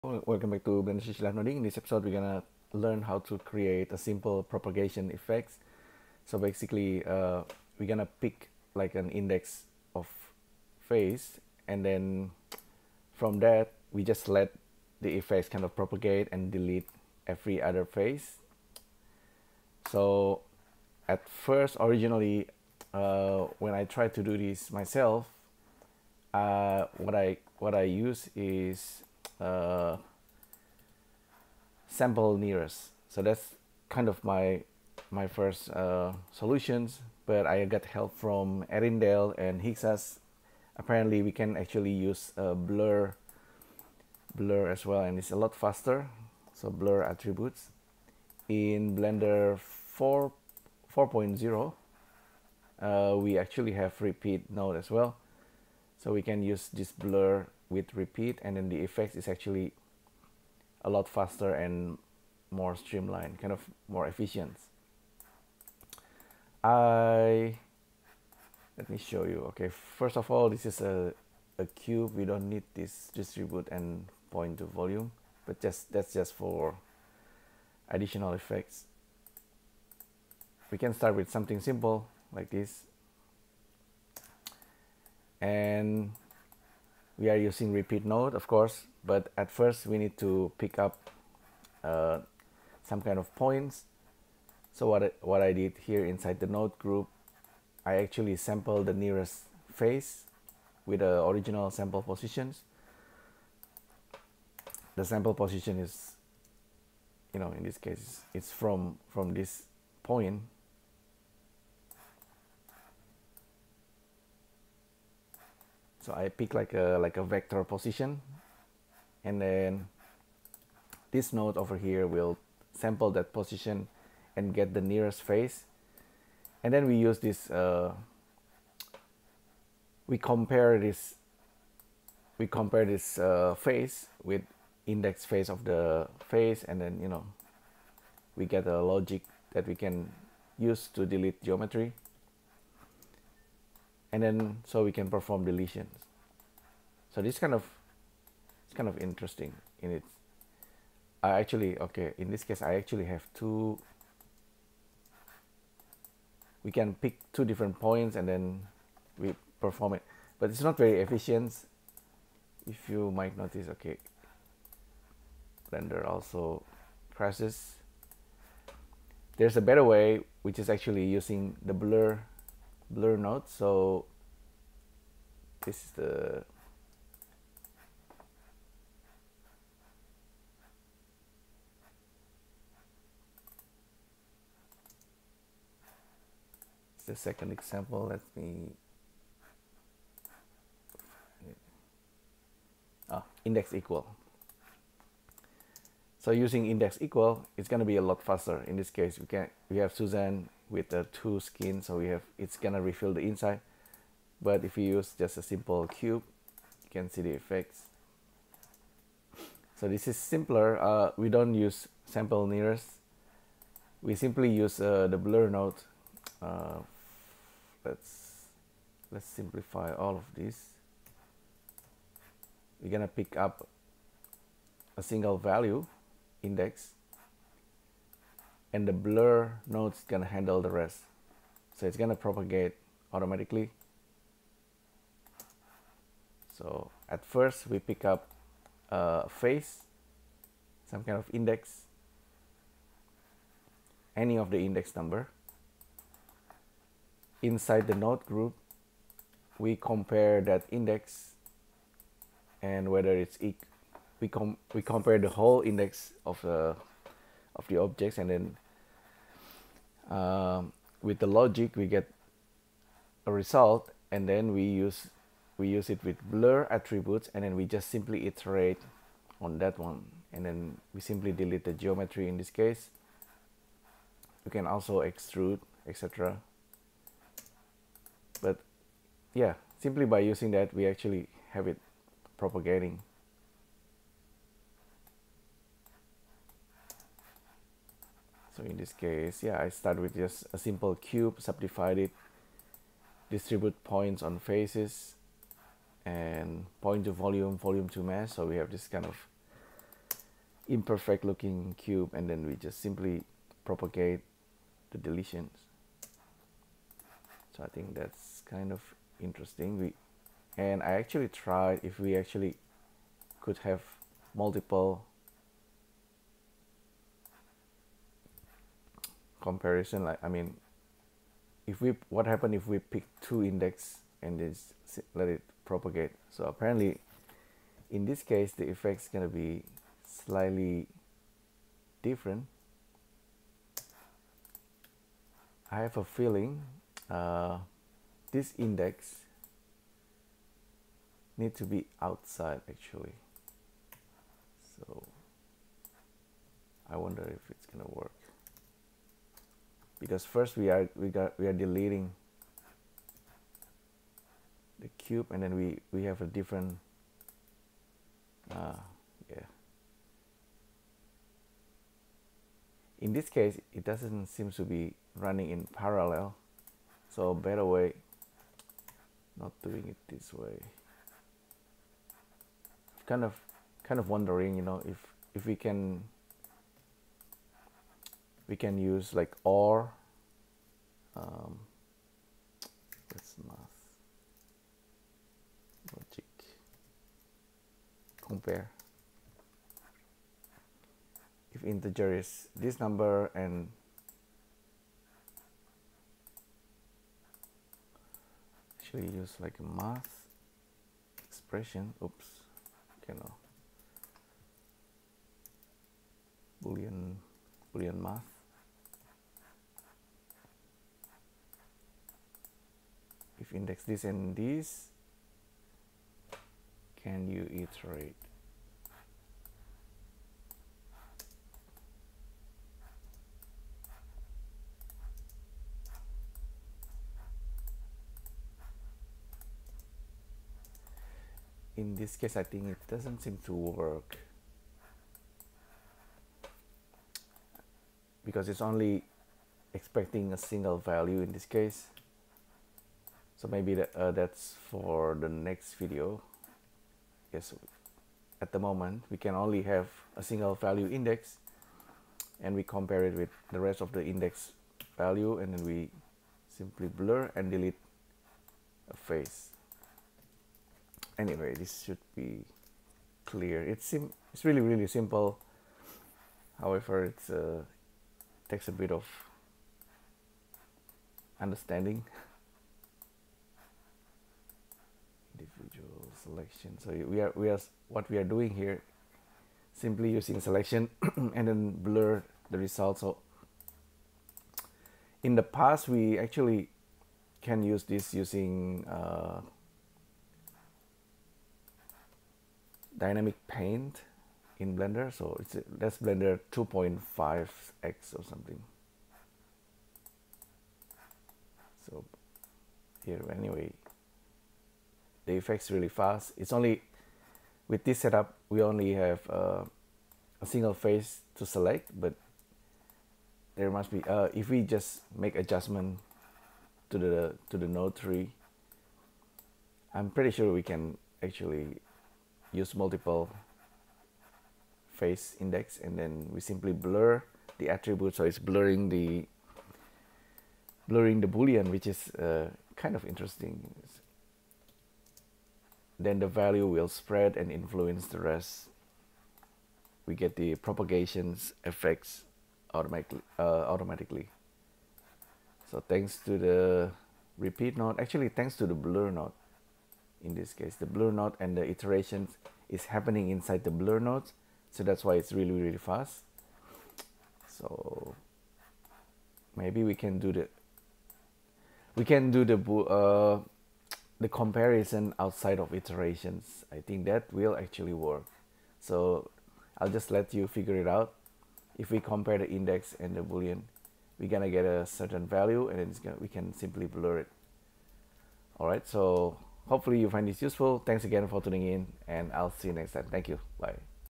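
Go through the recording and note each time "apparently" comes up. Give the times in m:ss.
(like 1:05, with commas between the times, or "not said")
0:40, 5:26.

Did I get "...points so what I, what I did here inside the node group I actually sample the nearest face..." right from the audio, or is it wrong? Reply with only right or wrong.
right.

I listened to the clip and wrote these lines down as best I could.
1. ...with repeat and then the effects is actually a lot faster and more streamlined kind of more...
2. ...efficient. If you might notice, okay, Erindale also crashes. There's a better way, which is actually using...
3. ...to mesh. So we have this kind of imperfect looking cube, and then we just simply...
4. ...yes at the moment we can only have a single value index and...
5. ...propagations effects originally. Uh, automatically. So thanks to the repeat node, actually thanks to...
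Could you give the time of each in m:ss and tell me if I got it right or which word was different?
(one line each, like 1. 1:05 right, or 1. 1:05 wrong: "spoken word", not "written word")
1. 0:57 right
2. 2:41 wrong: "Blender", not "Erindale"
3. 4:57 right
4. 7:27 right
5. 9:00 wrong: "automatically", not "originally".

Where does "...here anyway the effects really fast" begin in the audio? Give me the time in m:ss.
8:23.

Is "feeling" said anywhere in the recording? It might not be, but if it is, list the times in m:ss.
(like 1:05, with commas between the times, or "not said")
5:36.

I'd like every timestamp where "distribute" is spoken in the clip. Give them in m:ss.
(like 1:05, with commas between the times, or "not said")
1:13, 4:53.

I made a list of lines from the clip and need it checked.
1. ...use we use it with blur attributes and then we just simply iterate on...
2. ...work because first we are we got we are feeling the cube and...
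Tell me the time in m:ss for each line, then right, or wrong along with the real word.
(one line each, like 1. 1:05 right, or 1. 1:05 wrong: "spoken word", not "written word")
1. 4:24 right
2. 5:47 wrong: "deleting", not "feeling".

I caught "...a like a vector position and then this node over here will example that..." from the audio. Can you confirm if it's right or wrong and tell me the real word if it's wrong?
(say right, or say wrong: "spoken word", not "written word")
wrong: "sample", not "example".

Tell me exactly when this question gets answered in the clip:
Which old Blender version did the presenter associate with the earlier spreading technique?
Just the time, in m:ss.
8:16.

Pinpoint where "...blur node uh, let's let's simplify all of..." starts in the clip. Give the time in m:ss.
3:35.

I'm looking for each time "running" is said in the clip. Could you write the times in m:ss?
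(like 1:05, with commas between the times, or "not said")
6:05.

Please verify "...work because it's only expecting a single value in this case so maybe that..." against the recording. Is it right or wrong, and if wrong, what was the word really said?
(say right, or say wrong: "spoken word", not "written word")
right.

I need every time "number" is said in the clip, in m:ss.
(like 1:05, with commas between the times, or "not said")
4:04, 6:32.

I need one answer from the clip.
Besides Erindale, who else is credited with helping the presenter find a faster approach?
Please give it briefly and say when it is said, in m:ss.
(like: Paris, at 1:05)
Higgsas, at 0:39.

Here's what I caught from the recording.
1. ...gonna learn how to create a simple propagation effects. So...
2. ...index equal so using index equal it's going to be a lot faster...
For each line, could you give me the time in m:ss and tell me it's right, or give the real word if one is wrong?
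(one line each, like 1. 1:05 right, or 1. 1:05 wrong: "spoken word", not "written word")
1. 0:02 right
2. 3:13 right.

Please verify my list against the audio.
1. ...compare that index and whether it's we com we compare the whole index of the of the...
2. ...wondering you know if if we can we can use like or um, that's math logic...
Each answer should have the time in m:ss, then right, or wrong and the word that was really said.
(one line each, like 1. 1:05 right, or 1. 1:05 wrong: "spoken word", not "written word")
1. 4:09 right
2. 6:14 right.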